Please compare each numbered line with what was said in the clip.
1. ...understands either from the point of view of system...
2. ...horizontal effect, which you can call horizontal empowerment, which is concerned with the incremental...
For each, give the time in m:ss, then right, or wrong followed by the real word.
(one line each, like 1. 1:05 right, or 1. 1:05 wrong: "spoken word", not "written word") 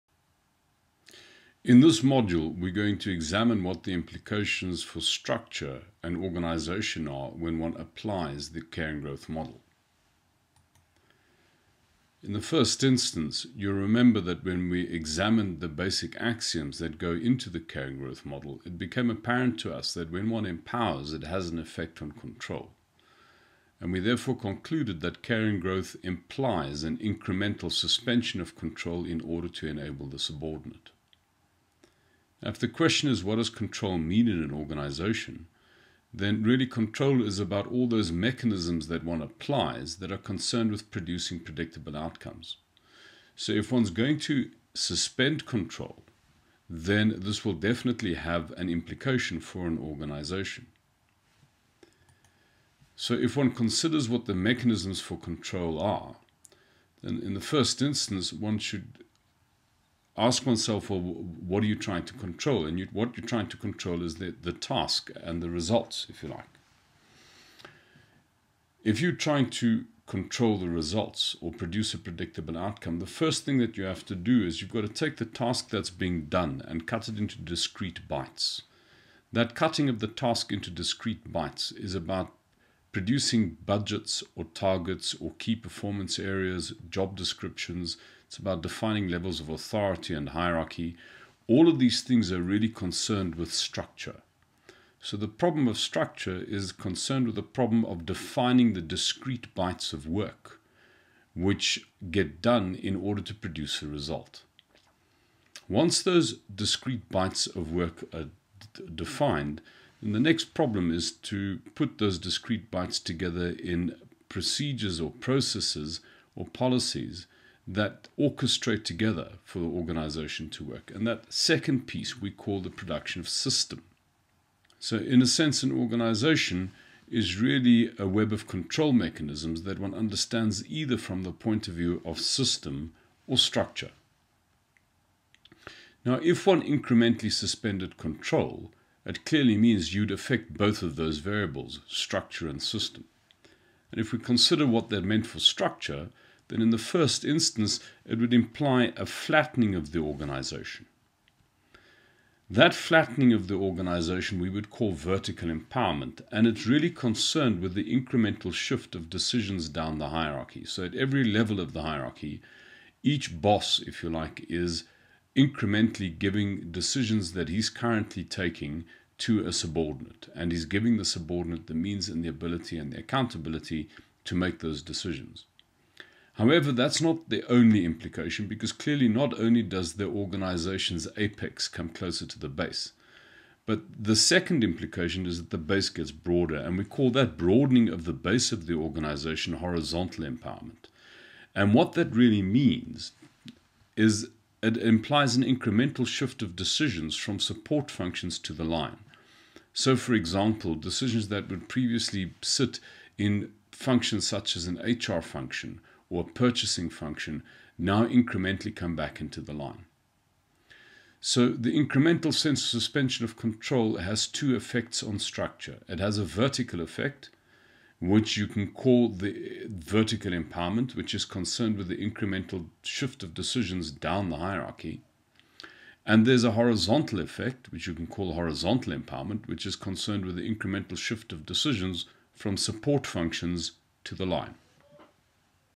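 1. 2:09 right
2. 3:46 right.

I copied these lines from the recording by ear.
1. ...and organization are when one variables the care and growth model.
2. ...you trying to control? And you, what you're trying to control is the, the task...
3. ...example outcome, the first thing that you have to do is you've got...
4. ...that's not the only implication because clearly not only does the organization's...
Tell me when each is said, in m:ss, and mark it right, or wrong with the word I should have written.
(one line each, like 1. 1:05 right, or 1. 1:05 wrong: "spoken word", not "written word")
1. 0:06 wrong: "applies", not "variables"
2. 1:01 right
3. 1:11 wrong: "predictable", not "example"
4. 2:56 right.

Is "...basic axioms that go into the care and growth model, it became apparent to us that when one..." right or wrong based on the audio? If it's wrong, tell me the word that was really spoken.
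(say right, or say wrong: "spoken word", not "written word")
right.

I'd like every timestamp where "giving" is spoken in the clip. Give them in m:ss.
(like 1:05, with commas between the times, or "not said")
2:46, 2:50.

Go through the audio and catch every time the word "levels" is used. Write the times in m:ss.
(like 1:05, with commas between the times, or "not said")
1:29, 2:41.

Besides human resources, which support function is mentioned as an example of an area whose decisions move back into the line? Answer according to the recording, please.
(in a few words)
purchasing.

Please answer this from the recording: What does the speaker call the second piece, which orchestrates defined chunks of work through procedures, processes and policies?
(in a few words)
production of system.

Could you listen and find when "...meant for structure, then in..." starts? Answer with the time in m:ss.
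2:25.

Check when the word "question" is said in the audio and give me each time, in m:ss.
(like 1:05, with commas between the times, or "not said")
0:32.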